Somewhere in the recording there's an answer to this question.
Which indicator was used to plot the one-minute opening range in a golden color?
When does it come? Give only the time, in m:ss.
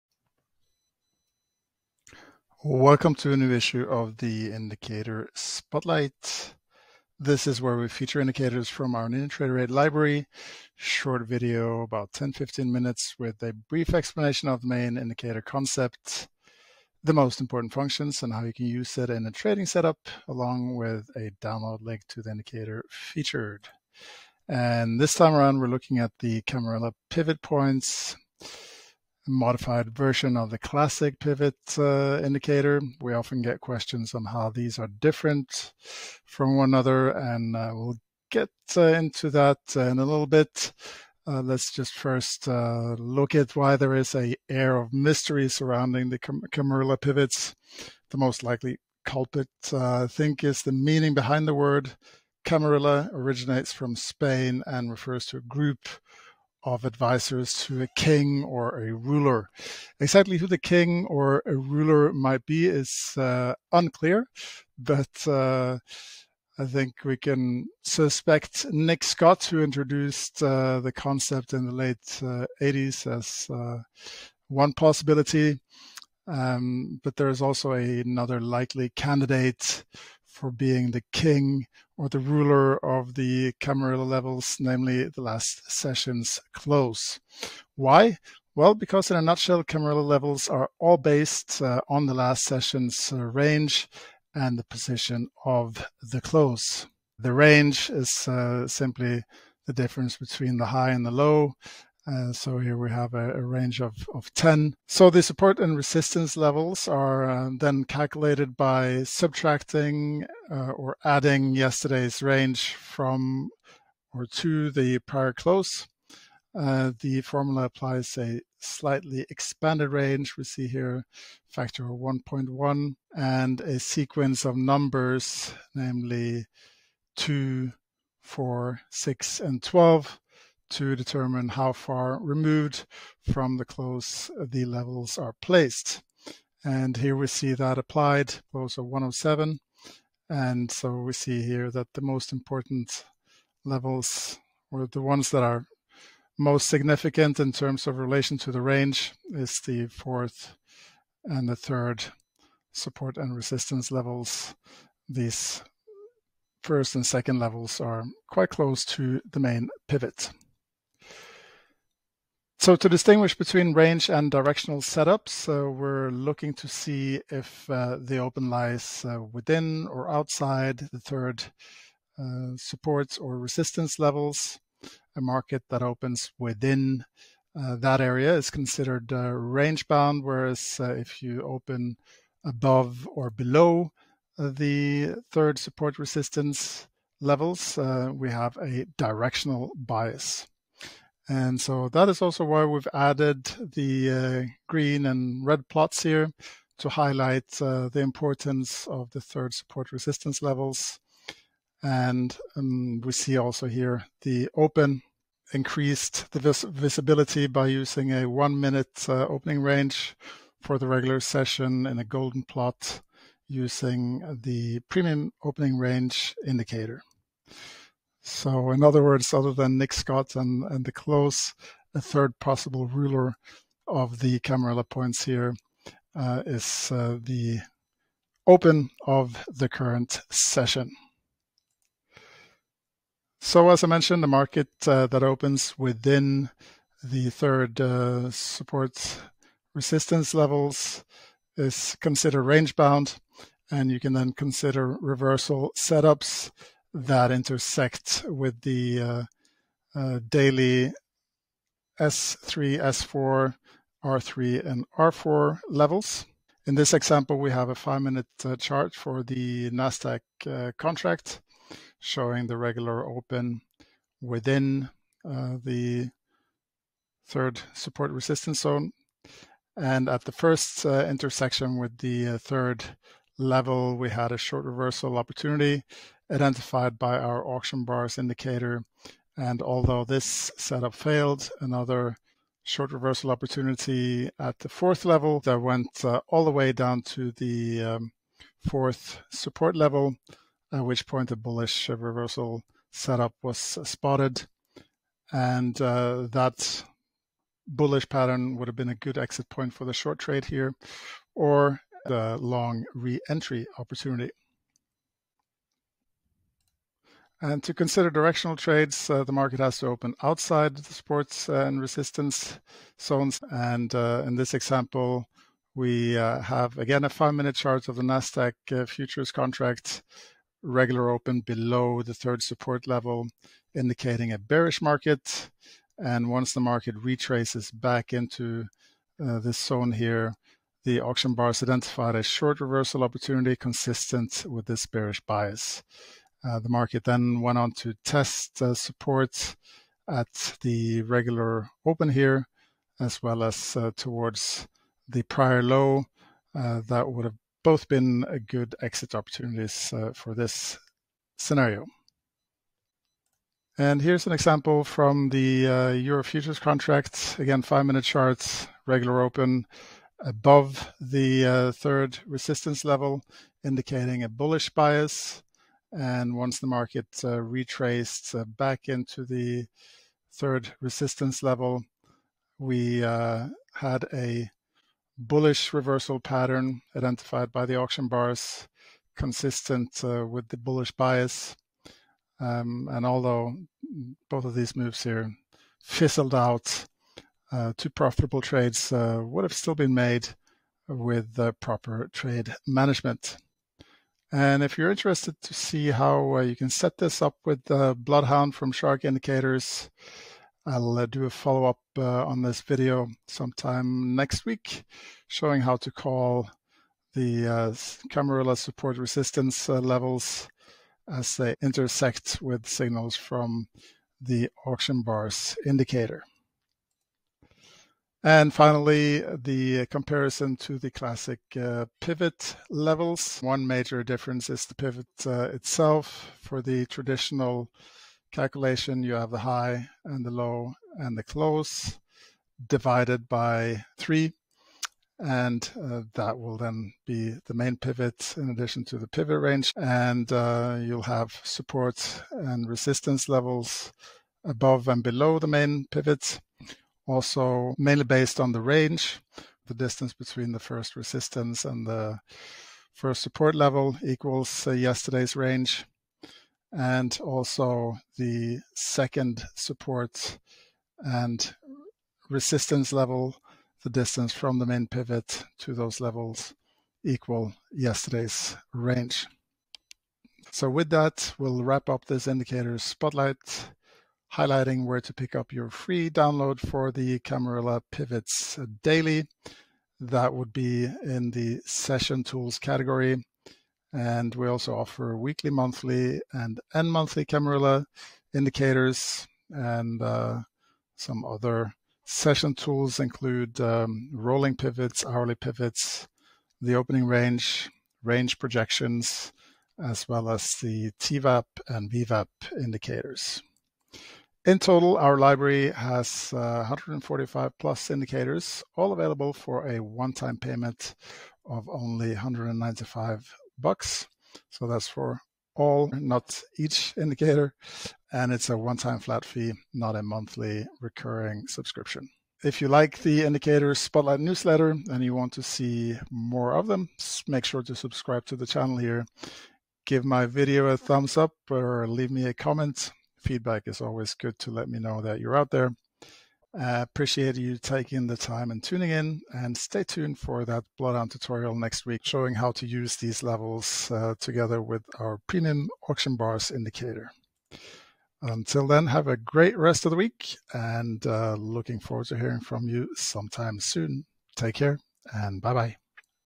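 3:34.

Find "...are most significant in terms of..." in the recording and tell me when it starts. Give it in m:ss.
2:25.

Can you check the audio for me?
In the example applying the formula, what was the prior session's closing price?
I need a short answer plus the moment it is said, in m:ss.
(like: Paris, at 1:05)
107, at 2:18.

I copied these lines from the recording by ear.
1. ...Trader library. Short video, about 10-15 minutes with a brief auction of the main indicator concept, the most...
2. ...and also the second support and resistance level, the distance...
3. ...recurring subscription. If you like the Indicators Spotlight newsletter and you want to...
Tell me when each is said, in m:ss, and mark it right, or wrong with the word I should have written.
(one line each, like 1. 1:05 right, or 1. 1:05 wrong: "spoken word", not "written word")
1. 0:09 wrong: "explanation", not "auction"
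2. 7:36 right
3. 8:40 right.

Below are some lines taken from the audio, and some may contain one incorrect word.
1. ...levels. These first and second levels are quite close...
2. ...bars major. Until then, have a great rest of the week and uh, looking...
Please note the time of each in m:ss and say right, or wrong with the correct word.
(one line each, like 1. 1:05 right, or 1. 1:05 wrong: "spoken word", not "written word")
1. 2:33 right
2. 9:06 wrong: "indicator", not "major".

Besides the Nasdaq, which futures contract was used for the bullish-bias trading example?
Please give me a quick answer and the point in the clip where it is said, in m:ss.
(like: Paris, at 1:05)
Euro futures, at 5:55.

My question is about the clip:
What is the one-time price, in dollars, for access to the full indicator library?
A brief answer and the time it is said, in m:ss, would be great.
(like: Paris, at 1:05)
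195, at 8:32.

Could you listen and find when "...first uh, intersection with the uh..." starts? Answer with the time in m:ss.
4:30.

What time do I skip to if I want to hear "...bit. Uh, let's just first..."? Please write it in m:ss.
0:40.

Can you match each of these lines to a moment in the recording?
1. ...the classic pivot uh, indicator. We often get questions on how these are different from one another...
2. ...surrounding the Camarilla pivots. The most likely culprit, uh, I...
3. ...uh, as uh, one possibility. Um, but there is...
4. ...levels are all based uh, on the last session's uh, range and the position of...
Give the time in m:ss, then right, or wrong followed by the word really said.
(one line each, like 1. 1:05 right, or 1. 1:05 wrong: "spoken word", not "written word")
1. 0:30 right
2. 0:45 right
3. 1:13 right
4. 1:30 right.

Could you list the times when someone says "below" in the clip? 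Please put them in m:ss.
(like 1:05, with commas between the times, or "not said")
3:03, 5:21, 7:25.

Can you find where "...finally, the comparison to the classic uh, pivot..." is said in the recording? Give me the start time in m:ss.
6:58.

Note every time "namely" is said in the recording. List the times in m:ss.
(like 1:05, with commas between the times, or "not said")
1:24, 2:05.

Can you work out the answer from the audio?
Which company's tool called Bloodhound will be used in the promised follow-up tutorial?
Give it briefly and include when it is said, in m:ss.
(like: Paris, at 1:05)
Shark Indicators, at 6:38.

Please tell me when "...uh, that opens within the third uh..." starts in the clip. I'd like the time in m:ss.
3:54.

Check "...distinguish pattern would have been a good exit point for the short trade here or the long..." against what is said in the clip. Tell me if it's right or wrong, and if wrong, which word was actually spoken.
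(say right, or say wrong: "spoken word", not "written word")
wrong: "bullish", not "distinguish".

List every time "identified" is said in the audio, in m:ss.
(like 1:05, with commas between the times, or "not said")
4:36, 5:31, 6:16.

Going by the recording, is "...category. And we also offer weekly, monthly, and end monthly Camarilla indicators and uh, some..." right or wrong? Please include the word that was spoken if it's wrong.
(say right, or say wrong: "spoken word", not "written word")
right.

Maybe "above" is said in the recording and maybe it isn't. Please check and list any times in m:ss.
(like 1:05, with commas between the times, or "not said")
3:02, 6:00, 7:24.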